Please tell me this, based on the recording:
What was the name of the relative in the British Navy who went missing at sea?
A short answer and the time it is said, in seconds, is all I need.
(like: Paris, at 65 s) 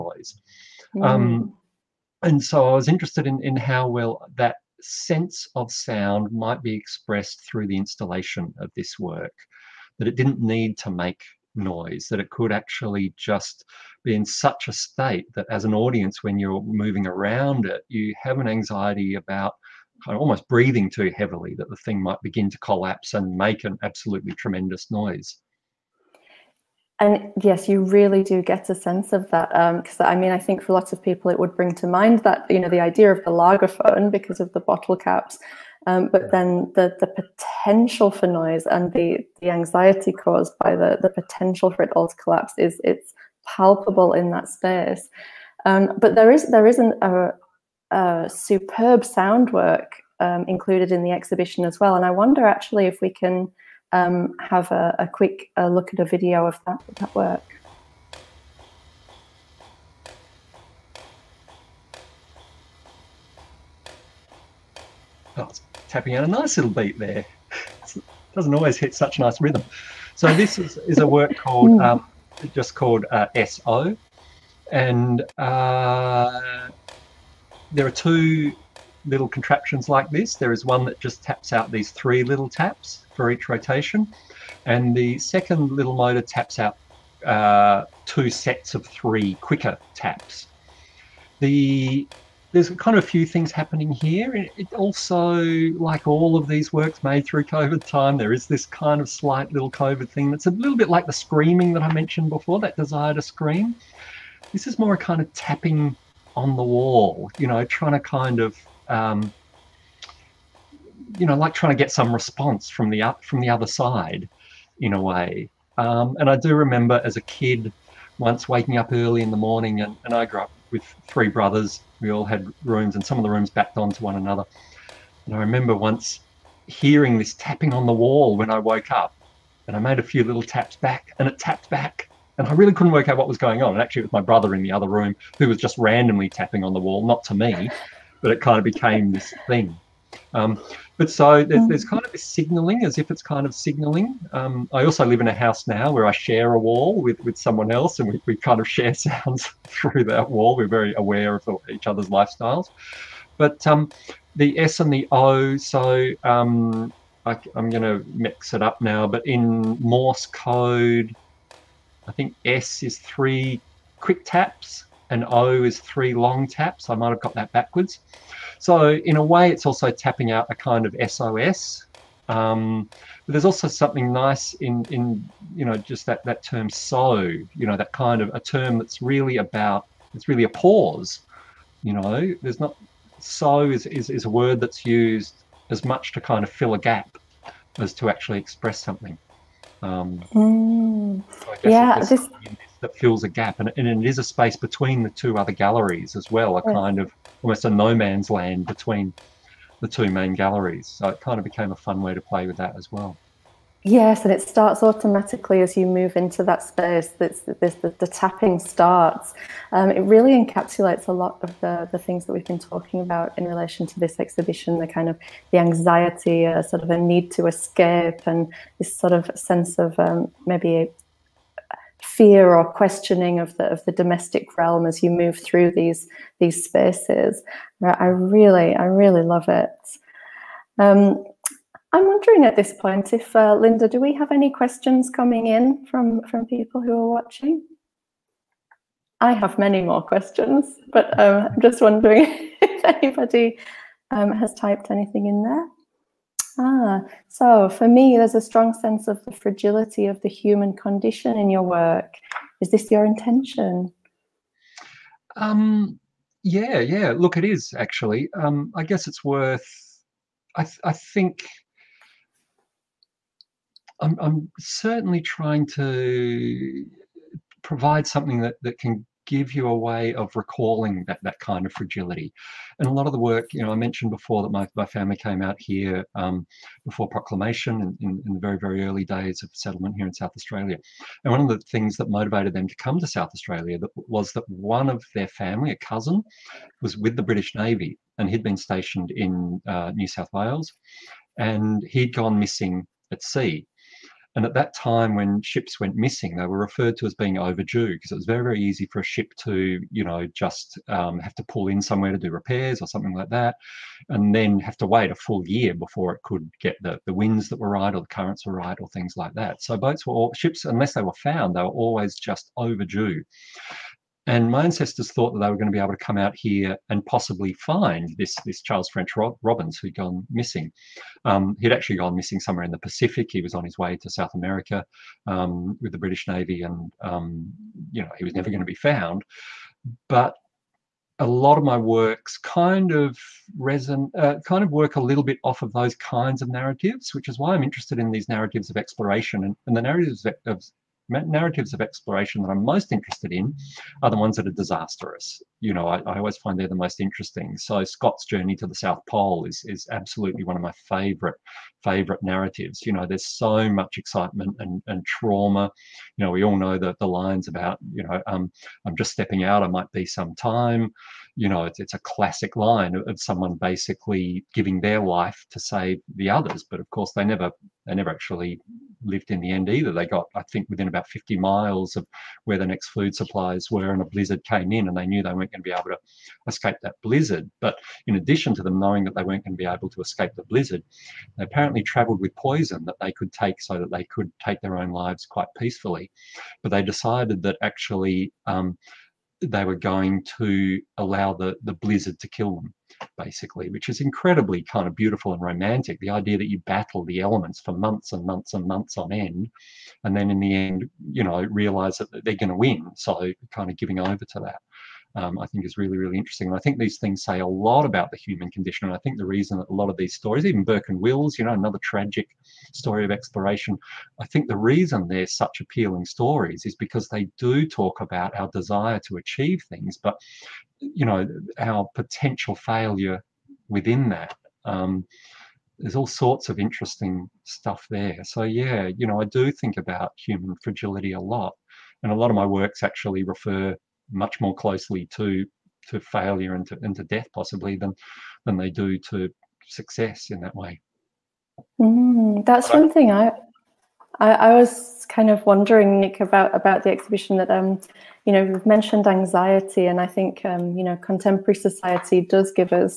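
Charles French Robbins, at 318 s.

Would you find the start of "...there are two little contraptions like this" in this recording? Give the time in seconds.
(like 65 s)
77 s.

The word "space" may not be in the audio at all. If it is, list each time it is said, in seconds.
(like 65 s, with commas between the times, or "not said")
44 s, 194 s, 206 s, 226 s.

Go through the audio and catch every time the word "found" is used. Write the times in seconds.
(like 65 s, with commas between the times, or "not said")
311 s, 328 s.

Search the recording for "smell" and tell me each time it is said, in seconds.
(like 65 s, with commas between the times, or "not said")
not said.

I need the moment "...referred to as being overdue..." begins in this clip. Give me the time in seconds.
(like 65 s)
296 s.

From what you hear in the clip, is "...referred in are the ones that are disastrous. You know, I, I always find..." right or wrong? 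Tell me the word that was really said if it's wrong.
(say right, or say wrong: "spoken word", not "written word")
wrong: "interested", not "referred".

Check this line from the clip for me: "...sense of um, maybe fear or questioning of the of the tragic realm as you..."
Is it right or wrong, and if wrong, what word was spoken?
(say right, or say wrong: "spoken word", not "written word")
wrong: "domestic", not "tragic".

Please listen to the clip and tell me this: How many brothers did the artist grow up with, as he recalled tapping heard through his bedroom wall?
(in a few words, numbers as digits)
3.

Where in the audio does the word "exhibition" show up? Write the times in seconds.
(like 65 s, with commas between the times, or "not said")
51 s, 214 s, 446 s.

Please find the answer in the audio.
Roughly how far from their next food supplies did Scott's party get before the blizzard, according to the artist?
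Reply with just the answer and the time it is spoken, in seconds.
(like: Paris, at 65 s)
50 miles, at 371 s.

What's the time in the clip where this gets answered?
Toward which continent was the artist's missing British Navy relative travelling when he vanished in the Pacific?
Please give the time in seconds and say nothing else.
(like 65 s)
324 s.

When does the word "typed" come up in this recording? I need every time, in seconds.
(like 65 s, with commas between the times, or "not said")
244 s.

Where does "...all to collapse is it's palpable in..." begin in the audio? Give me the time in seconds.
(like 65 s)
41 s.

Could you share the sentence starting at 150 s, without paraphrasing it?
We're very aware of each other's lifestyles.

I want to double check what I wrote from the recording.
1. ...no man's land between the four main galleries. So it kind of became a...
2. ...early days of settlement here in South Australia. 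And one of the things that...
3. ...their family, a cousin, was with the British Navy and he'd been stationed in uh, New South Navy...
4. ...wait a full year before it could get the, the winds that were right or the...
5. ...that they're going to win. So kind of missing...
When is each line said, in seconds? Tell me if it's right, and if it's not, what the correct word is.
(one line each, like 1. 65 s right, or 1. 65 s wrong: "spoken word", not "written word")
1. 197 s wrong: "two", not "four"
2. 278 s right
3. 285 s wrong: "Wales", not "Navy"
4. 304 s right
5. 401 s wrong: "giving", not "missing".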